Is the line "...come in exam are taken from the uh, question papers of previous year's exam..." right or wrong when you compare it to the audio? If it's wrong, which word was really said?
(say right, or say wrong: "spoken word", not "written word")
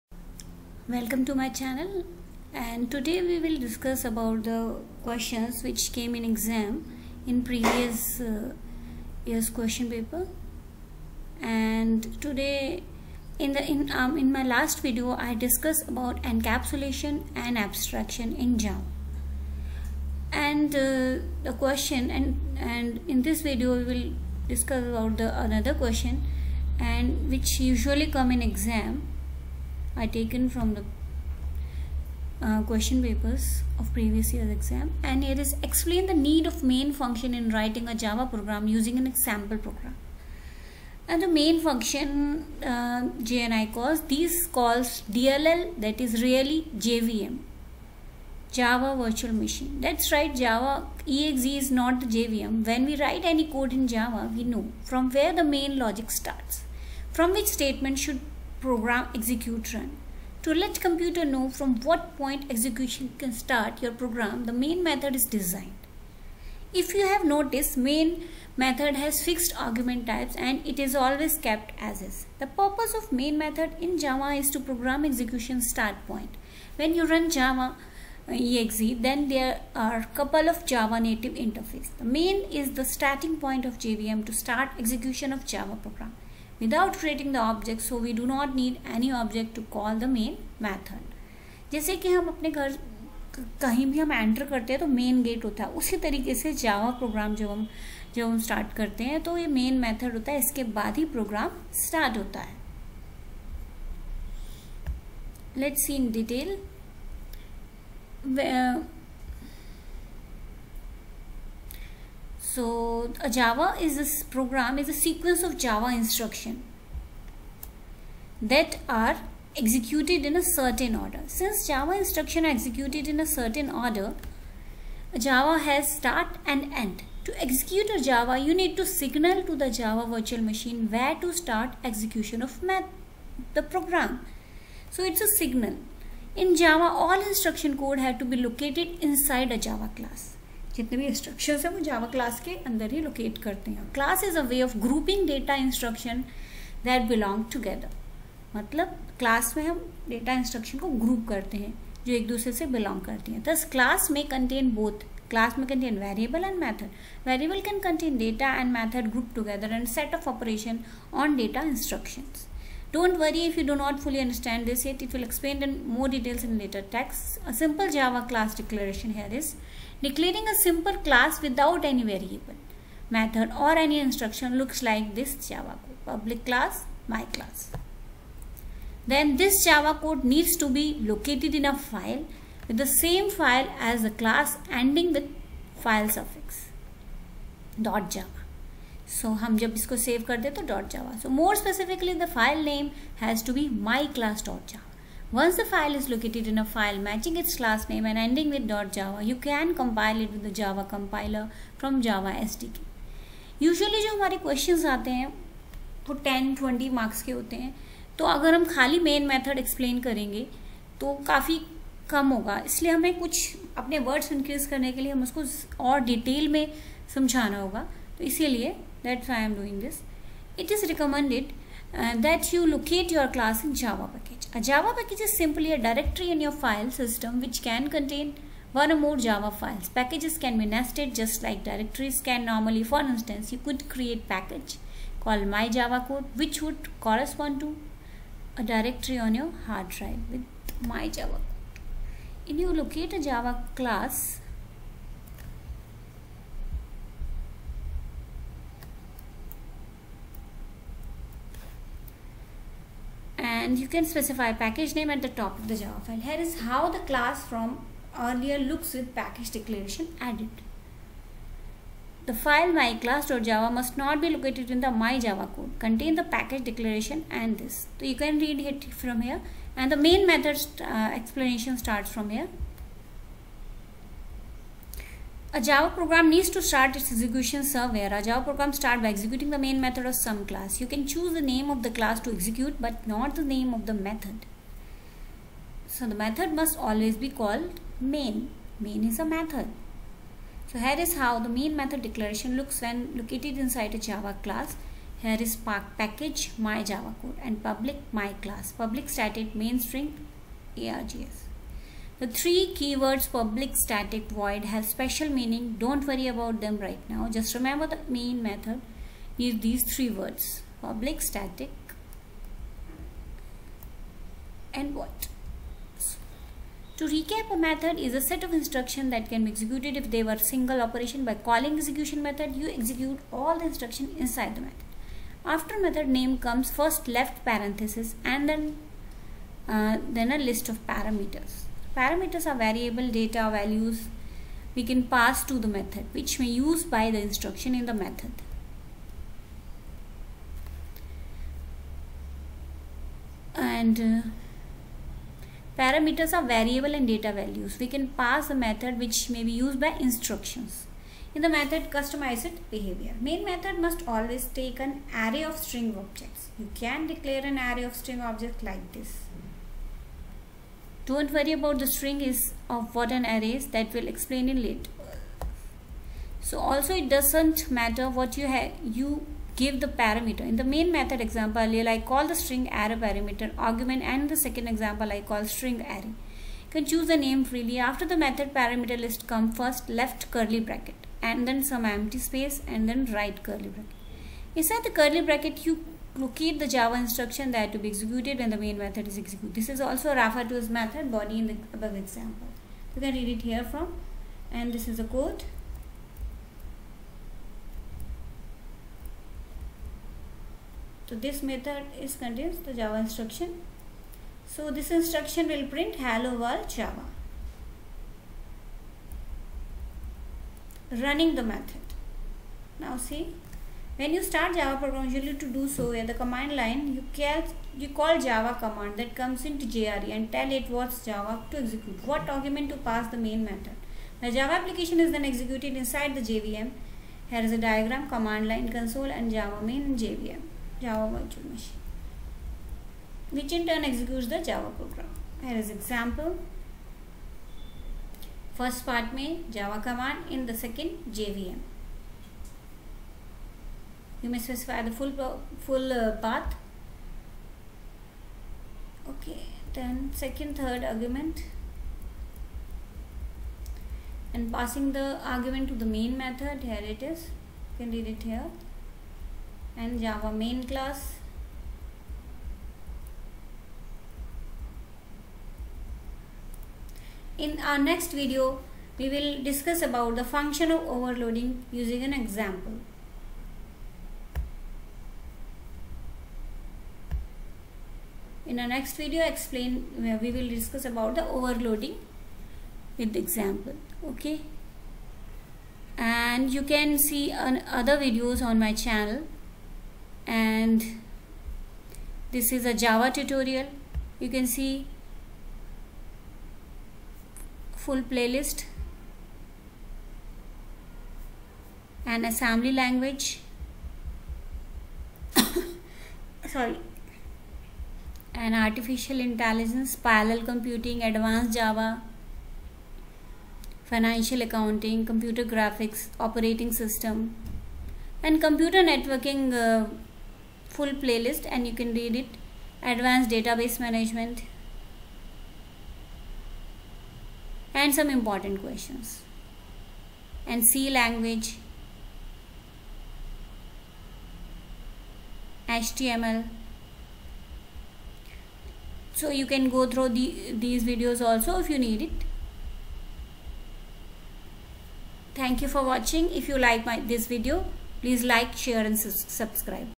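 right.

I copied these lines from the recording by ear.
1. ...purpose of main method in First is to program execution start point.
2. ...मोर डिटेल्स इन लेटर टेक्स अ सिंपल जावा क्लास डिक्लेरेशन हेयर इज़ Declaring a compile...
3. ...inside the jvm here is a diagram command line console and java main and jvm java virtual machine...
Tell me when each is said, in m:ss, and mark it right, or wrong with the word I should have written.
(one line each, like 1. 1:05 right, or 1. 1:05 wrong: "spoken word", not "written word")
1. 1:12 wrong: "Java", not "First"
2. 2:45 wrong: "simple", not "compile"
3. 7:05 right.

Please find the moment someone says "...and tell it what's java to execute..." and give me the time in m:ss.
7:00.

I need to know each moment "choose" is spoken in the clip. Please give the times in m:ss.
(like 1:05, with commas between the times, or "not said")
4:41, 6:16.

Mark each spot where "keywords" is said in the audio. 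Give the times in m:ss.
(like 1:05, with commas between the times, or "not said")
5:02.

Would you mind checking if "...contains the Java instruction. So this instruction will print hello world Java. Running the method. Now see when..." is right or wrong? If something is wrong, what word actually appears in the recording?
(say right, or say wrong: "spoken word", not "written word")
right.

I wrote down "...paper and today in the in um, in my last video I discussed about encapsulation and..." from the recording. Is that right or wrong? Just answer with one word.
right.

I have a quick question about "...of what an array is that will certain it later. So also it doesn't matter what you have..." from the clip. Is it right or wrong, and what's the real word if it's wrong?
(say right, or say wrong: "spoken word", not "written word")
wrong: "explain", not "certain".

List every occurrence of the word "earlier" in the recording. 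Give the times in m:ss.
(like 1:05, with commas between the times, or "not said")
4:18, 6:11.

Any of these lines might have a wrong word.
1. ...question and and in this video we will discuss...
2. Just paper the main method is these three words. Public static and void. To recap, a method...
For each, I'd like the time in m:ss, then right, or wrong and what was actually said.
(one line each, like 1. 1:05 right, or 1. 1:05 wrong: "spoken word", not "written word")
1. 0:21 right
2. 5:07 wrong: "remember", not "paper".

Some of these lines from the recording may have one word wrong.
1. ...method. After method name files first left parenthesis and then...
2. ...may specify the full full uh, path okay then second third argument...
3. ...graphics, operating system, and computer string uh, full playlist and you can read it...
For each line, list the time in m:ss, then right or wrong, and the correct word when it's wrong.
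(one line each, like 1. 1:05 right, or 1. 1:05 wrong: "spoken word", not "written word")
1. 5:24 wrong: "comes", not "files"
2. 7:24 right
3. 8:35 wrong: "networking", not "string".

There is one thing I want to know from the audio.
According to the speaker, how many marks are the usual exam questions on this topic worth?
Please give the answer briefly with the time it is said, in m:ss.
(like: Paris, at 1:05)
10 or 20, at 3:26.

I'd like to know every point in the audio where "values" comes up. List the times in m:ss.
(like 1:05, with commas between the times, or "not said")
5:33, 5:47.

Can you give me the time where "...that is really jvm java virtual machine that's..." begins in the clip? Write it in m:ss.
0:45.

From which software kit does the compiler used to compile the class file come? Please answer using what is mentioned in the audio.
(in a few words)
Java SDK.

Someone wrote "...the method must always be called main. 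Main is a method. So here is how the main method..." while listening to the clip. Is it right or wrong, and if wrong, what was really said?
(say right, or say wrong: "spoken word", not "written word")
right.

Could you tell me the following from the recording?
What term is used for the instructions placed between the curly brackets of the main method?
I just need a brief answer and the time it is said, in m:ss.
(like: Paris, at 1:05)
method body, at 6:30.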